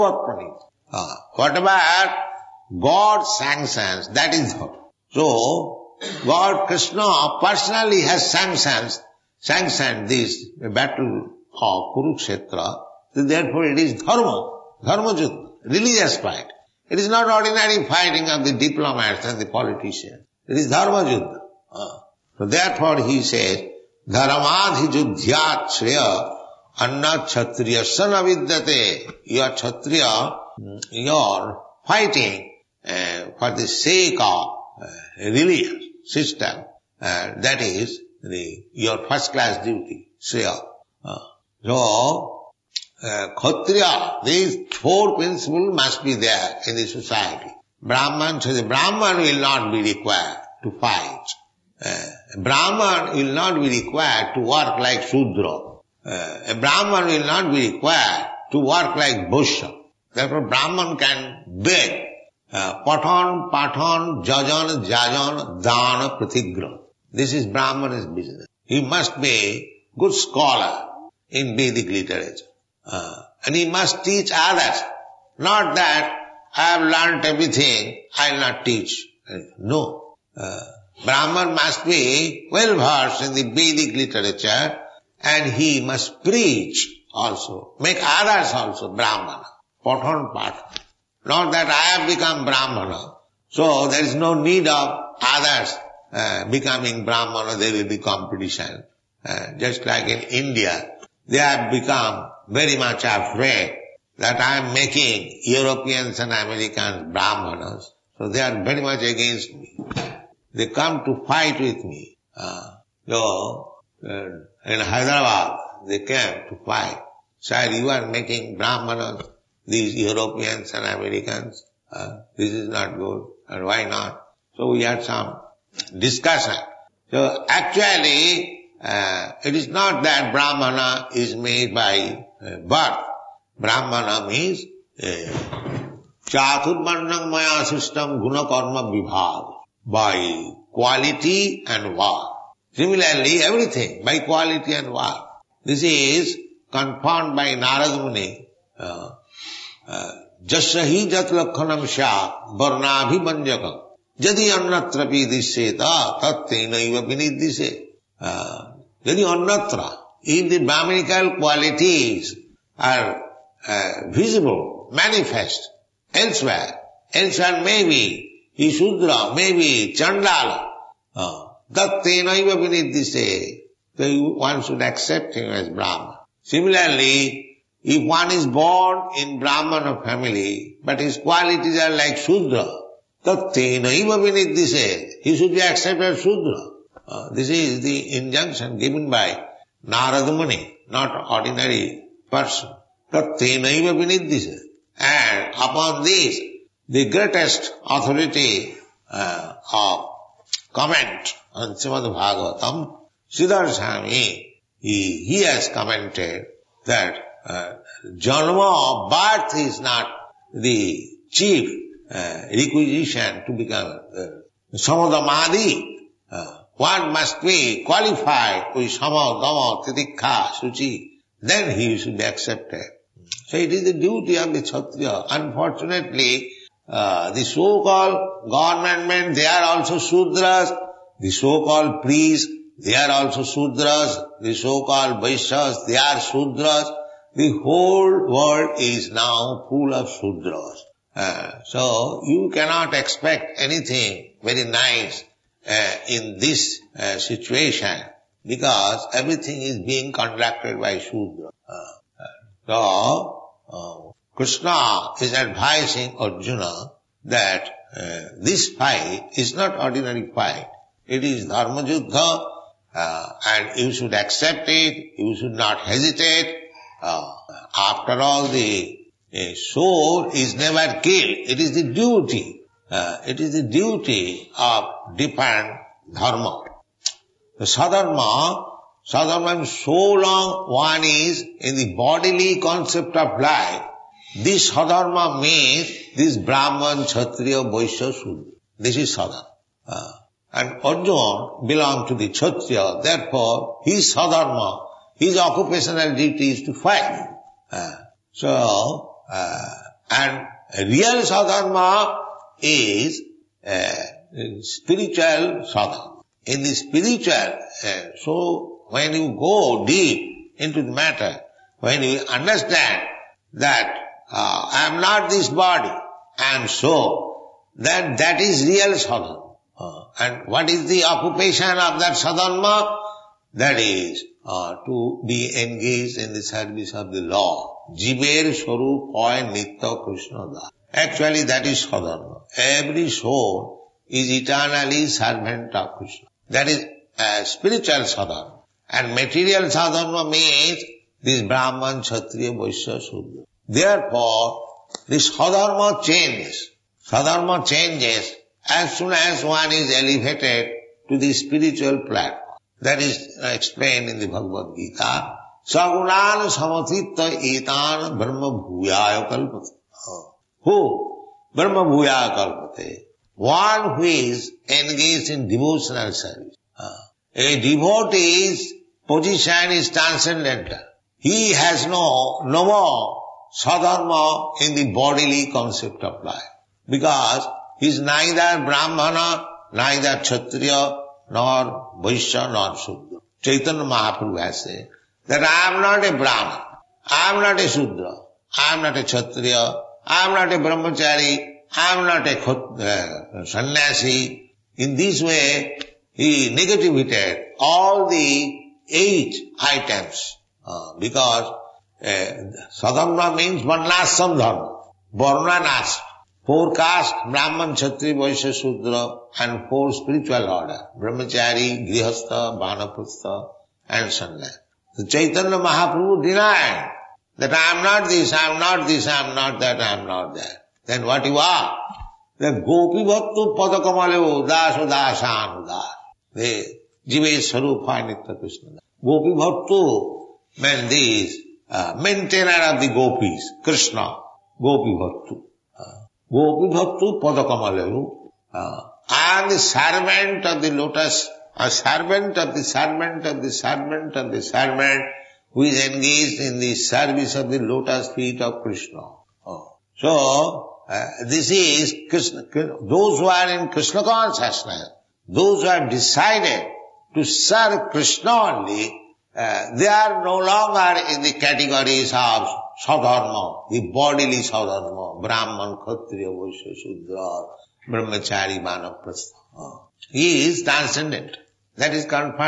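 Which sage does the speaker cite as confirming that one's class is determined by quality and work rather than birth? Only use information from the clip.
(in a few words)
Narad Muni.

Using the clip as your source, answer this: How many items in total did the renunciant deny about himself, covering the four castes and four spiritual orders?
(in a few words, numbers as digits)
8.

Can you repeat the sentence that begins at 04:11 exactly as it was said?
Uh, uh, so uh, Krishna is advising Arjuna that this fight is not ordinary fight.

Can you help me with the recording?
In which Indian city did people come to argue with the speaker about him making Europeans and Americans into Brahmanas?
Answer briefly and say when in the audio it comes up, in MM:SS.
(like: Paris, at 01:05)
Hyderabad, at 01:54.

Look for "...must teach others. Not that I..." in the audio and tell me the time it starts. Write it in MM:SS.
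01:13.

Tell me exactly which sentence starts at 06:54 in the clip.
So Chaitanya Mahaprabhu denied that I am not this, I am not this, I am not that, I am not that.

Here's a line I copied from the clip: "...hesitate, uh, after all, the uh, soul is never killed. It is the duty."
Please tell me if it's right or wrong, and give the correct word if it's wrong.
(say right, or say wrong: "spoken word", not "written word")
right.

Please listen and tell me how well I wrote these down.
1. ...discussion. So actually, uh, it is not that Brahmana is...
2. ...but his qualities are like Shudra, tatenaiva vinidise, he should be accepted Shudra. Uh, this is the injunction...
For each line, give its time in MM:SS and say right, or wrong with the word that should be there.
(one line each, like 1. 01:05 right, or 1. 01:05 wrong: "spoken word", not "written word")
1. 02:05 right
2. 03:00 right.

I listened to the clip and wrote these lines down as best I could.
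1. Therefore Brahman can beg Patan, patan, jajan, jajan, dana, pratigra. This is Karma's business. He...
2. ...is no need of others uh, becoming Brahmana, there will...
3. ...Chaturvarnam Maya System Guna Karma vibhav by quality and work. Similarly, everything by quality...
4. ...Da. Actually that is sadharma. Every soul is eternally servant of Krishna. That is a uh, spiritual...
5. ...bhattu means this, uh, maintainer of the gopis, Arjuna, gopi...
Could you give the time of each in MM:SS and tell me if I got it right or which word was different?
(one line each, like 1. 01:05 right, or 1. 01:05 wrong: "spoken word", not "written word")
1. 01:00 wrong: "Brahman", not "Karma"
2. 01:34 right
3. 02:16 right
4. 05:30 right
5. 07:09 wrong: "Krishna", not "Arjuna".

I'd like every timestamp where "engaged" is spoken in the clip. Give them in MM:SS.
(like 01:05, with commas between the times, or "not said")
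05:25, 06:04, 07:25.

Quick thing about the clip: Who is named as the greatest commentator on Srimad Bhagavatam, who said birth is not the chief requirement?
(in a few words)
Sridhar Swami.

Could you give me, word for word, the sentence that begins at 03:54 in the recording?
The so-called Vaishyas, they are Sudras.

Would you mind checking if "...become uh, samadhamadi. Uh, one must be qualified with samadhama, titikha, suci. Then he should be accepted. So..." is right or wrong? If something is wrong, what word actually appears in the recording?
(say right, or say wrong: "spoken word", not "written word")
right.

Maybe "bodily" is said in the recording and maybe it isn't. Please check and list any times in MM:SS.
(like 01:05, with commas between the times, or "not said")
04:41, 06:14.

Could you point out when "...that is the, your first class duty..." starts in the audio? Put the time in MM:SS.
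00:37.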